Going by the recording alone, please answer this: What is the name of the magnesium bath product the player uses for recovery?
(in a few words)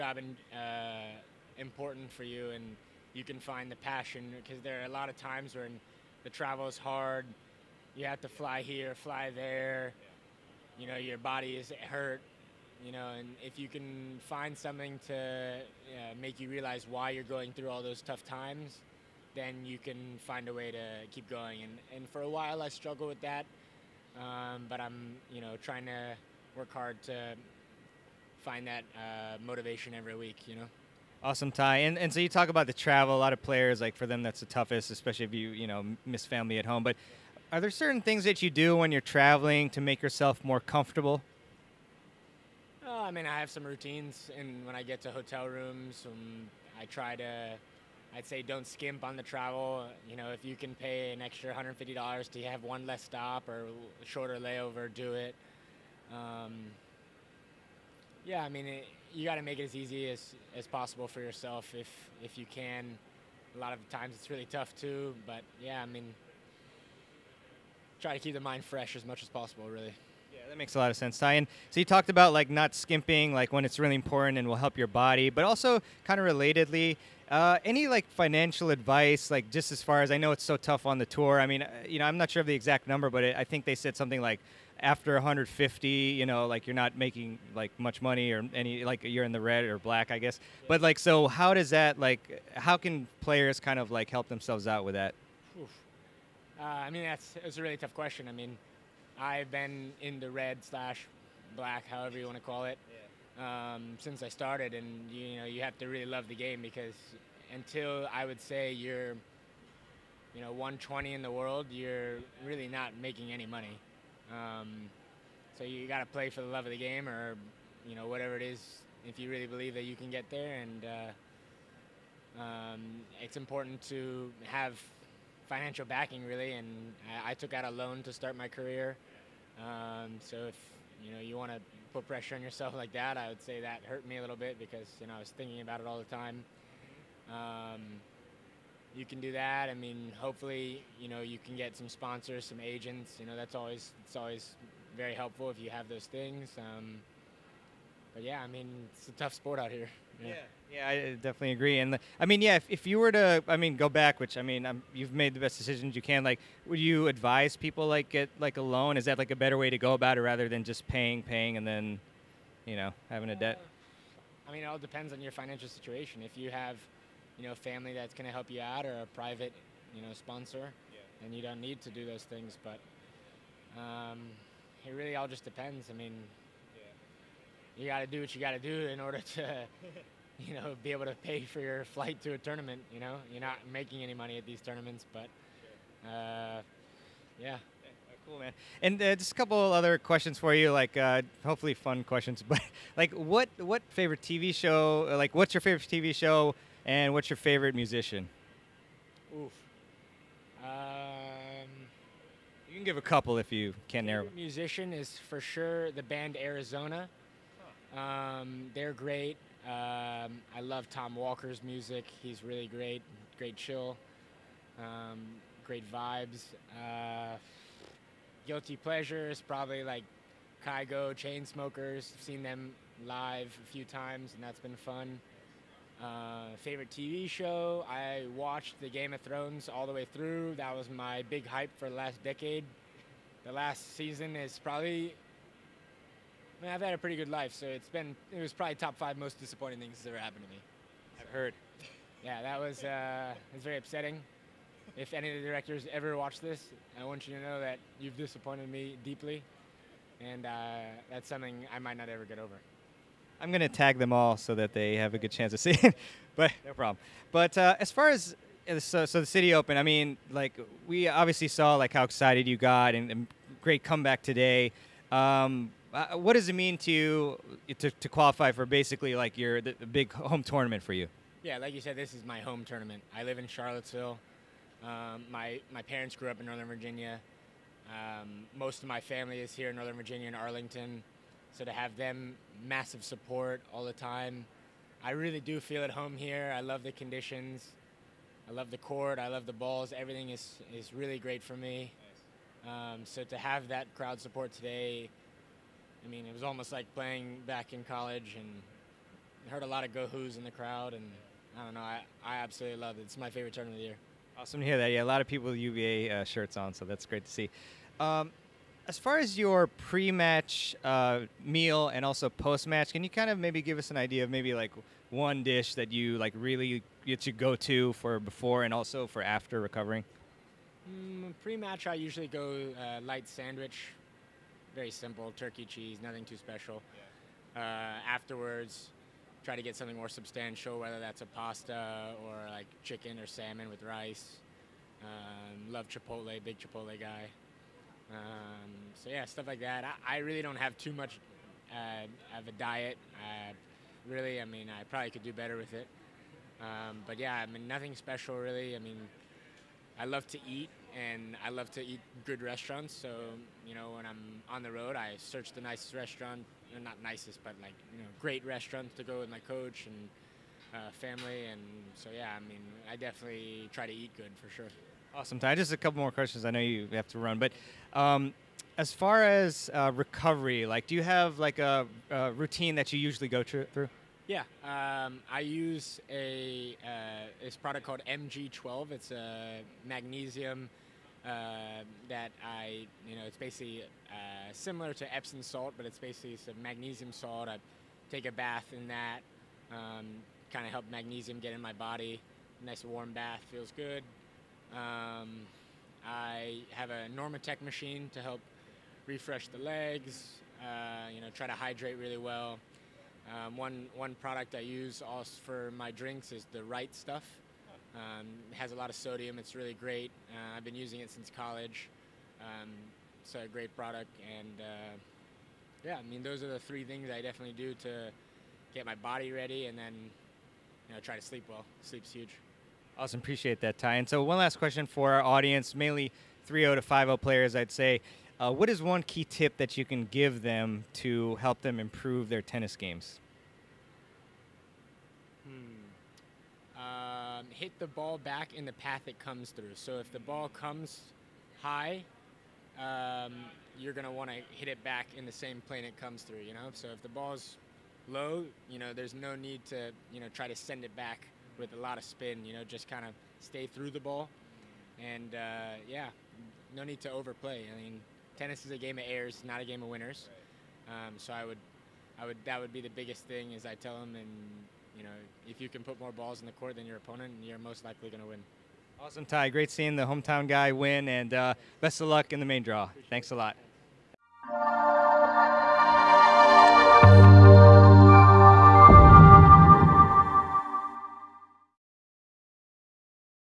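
MG12.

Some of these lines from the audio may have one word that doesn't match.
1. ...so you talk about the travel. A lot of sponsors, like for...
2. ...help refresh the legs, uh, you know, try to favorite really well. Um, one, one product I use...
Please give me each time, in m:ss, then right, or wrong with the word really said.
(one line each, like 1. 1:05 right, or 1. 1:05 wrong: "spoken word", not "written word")
1. 0:32 wrong: "players", not "sponsors"
2. 6:38 wrong: "hydrate", not "favorite".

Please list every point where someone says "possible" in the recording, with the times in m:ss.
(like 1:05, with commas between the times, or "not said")
1:00, 1:09.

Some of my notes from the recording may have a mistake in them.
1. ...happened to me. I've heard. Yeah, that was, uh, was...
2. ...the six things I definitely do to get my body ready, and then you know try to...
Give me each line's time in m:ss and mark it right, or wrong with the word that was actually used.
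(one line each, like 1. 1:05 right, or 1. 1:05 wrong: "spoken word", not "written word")
1. 4:00 right
2. 6:56 wrong: "three", not "six".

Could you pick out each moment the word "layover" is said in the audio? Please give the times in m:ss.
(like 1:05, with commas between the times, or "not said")
0:54.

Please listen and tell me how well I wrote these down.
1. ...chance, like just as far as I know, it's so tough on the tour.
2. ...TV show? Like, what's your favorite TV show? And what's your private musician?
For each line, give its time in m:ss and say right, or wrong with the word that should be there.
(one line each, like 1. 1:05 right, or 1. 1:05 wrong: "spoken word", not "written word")
1. 1:18 wrong: "advice", not "chance"
2. 3:14 wrong: "favorite", not "private".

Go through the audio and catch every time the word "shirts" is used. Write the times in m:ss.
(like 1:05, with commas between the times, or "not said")
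5:06.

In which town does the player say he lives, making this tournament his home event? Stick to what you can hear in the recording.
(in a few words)
Charlottesville.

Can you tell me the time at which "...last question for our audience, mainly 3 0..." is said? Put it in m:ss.
7:04.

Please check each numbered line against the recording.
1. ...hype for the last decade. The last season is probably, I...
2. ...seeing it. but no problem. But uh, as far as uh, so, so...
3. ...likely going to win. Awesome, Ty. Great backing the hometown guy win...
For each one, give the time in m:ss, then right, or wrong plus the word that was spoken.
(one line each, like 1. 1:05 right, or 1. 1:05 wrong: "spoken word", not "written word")
1. 3:51 right
2. 4:15 right
3. 7:47 wrong: "seeing", not "backing".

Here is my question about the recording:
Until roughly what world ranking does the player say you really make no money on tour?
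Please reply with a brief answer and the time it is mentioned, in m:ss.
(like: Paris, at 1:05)
120, at 1:50.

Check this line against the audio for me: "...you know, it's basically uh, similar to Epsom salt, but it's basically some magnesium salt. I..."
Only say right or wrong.
right.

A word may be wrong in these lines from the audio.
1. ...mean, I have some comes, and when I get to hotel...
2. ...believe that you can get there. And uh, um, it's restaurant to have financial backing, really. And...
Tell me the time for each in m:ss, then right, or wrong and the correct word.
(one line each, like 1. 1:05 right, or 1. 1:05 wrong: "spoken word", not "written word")
1. 0:43 wrong: "routines", not "comes"
2. 1:59 wrong: "important", not "restaurant".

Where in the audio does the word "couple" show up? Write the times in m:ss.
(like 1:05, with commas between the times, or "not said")
3:09, 3:23, 6:05.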